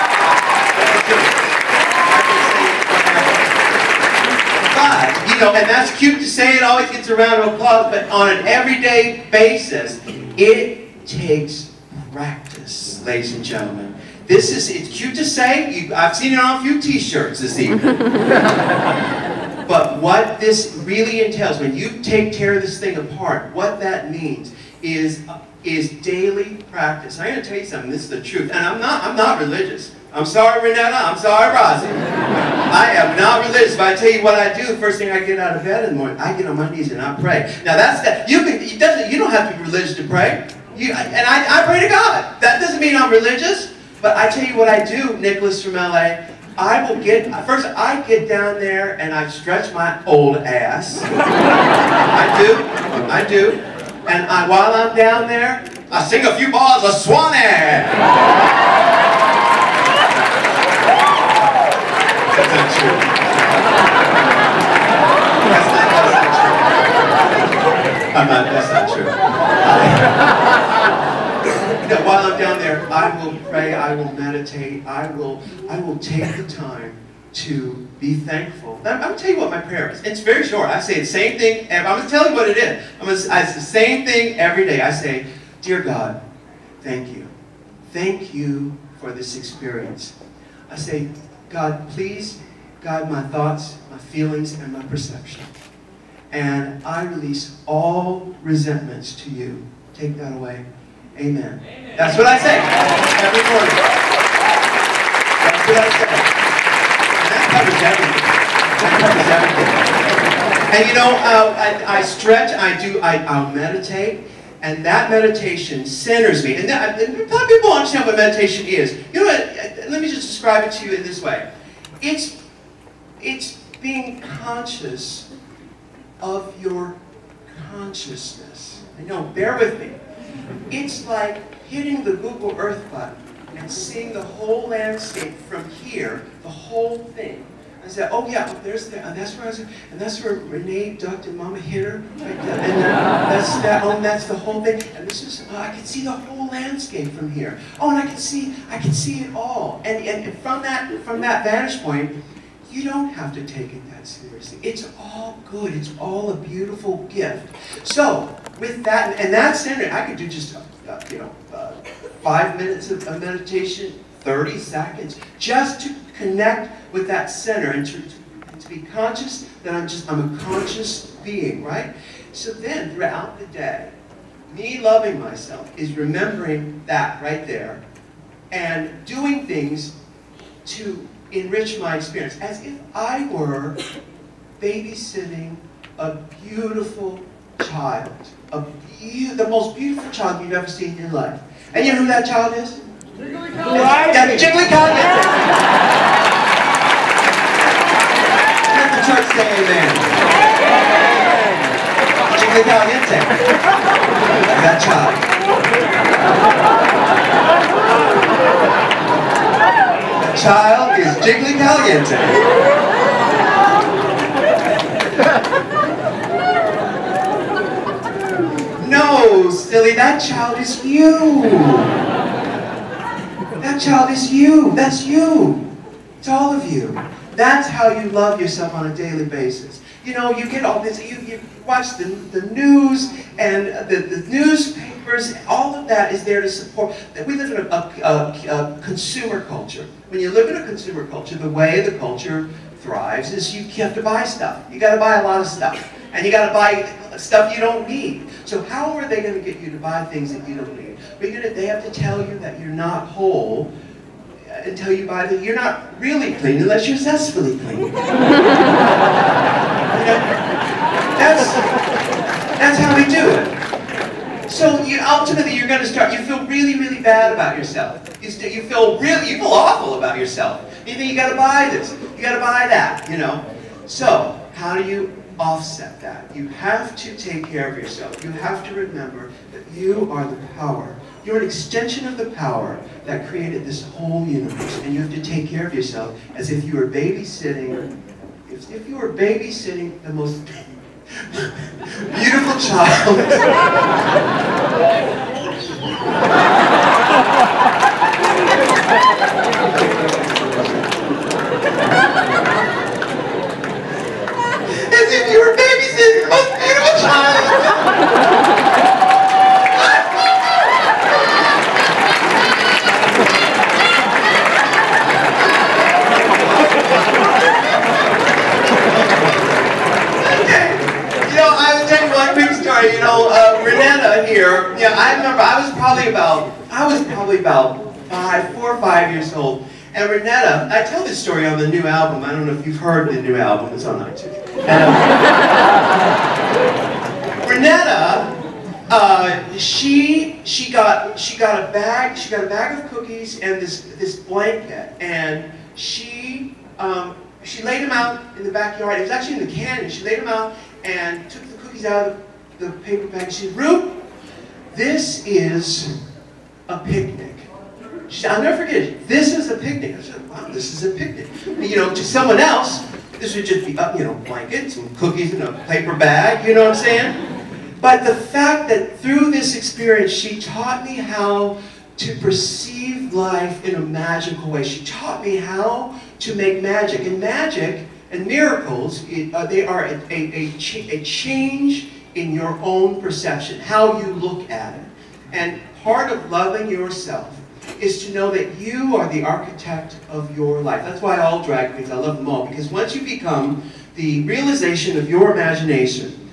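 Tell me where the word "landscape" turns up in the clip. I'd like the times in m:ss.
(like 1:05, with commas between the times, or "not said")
2:14, 2:26.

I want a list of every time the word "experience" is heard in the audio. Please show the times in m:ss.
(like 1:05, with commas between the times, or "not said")
1:29, 3:01, 6:09.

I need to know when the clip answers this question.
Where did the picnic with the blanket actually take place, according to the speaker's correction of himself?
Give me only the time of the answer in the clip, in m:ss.
5:49.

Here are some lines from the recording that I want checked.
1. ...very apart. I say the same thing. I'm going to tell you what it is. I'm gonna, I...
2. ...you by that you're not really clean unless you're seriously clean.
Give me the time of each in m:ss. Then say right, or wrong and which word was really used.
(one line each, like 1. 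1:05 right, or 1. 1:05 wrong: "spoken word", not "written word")
1. 1:20 wrong: "short", not "apart"
2. 4:14 wrong: "zestfully", not "seriously".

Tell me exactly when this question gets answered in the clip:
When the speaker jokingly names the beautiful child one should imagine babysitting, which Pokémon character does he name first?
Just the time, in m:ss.
3:13.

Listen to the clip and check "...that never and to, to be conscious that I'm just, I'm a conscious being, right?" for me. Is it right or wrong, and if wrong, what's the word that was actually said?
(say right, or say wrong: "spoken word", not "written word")
wrong: "center", not "never".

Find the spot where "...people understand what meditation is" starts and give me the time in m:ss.
1:57.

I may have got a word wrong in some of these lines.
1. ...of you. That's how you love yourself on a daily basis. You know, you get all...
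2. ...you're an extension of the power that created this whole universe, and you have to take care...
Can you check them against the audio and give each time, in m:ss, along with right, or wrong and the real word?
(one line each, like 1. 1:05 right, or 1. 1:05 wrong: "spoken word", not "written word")
1. 3:46 right
2. 4:41 right.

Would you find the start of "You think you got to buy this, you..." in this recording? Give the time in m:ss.
4:30.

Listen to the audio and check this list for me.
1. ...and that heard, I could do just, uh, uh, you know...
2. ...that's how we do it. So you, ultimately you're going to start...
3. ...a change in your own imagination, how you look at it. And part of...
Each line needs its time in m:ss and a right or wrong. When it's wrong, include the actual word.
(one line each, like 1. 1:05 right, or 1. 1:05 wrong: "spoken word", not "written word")
1. 2:39 wrong: "standard", not "heard"
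2. 4:22 right
3. 6:20 wrong: "perception", not "imagination".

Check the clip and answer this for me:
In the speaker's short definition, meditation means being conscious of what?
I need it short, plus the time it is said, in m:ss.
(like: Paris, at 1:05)
your consciousness, at 2:06.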